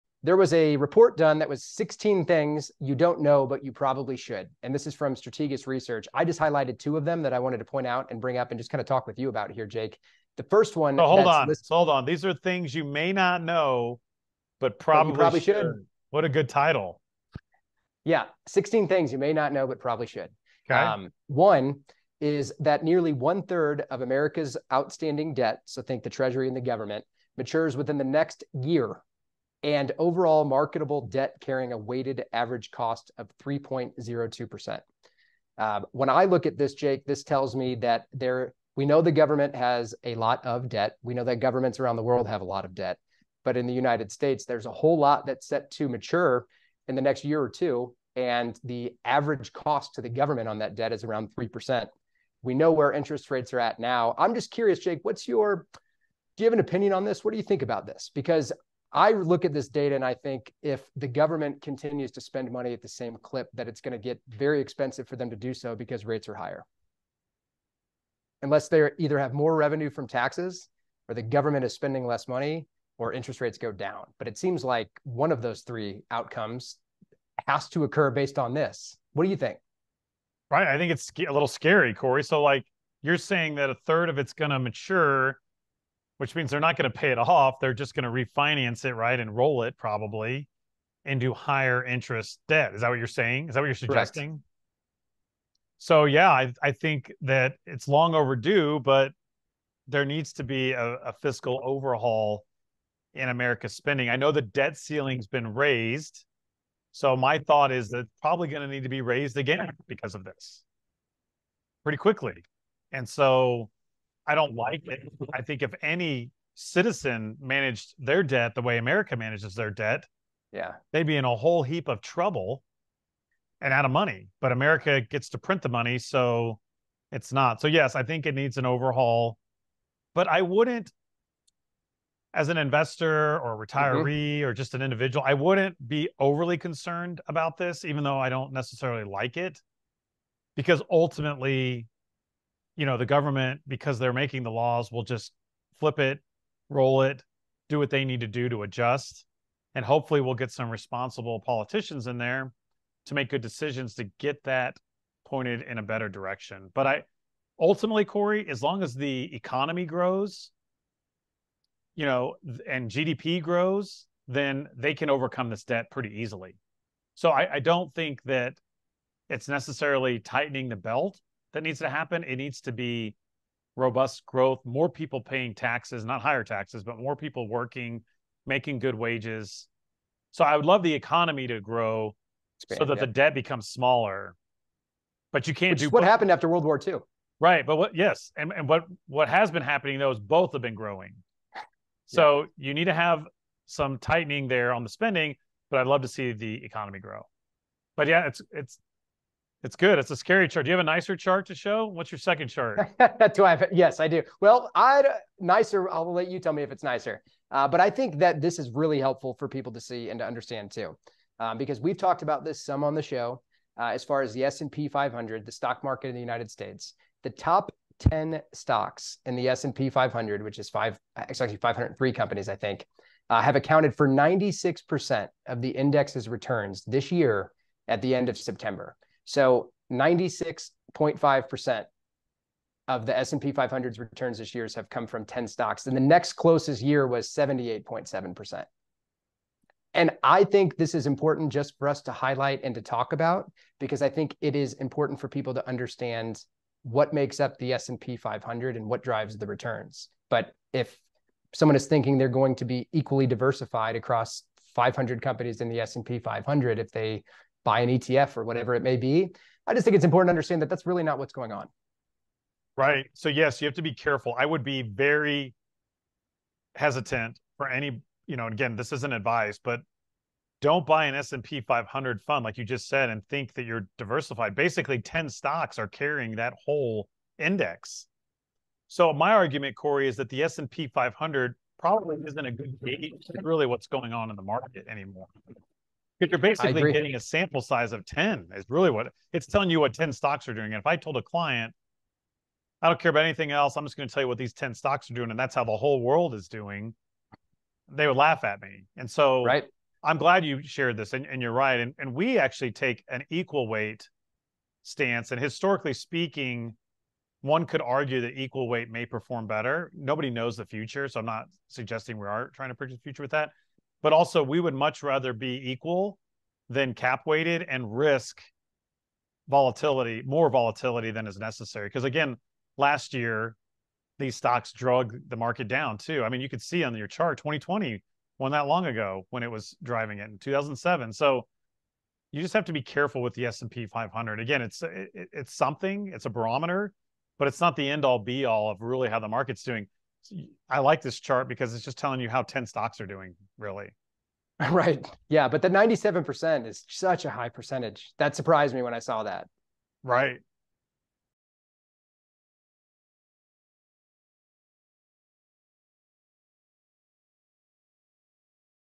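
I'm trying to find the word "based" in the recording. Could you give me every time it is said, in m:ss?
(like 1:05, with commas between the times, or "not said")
1:18.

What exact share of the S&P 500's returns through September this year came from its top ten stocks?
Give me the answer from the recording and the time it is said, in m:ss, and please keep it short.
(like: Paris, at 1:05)
96.5%, at 3:49.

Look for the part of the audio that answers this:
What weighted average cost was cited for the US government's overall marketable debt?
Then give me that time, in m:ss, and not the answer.
0:33.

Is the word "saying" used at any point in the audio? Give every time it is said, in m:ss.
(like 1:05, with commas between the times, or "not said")
1:23, 1:33.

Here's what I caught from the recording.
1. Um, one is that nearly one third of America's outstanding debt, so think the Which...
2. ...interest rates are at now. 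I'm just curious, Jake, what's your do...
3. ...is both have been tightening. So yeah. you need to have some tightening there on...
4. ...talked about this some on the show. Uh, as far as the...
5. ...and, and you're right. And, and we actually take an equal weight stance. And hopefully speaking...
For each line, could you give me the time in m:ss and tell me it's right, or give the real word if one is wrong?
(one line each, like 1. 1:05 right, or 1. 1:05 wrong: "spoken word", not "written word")
1. 0:20 wrong: "Treasury", not "Which"
2. 0:52 right
3. 3:10 wrong: "growing", not "tightening"
4. 3:31 right
5. 5:01 wrong: "historically", not "hopefully".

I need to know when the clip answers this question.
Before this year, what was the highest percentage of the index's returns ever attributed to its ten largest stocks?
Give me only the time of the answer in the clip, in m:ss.
3:57.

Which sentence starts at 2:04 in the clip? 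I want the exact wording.
But America gets to print the money, so it's not.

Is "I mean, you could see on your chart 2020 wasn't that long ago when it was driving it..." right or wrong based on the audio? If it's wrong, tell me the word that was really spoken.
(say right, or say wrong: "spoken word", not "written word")
right.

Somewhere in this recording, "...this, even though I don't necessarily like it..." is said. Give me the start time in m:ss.
2:17.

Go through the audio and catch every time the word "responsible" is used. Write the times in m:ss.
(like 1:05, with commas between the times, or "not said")
2:30.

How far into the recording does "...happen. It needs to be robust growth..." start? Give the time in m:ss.
2:51.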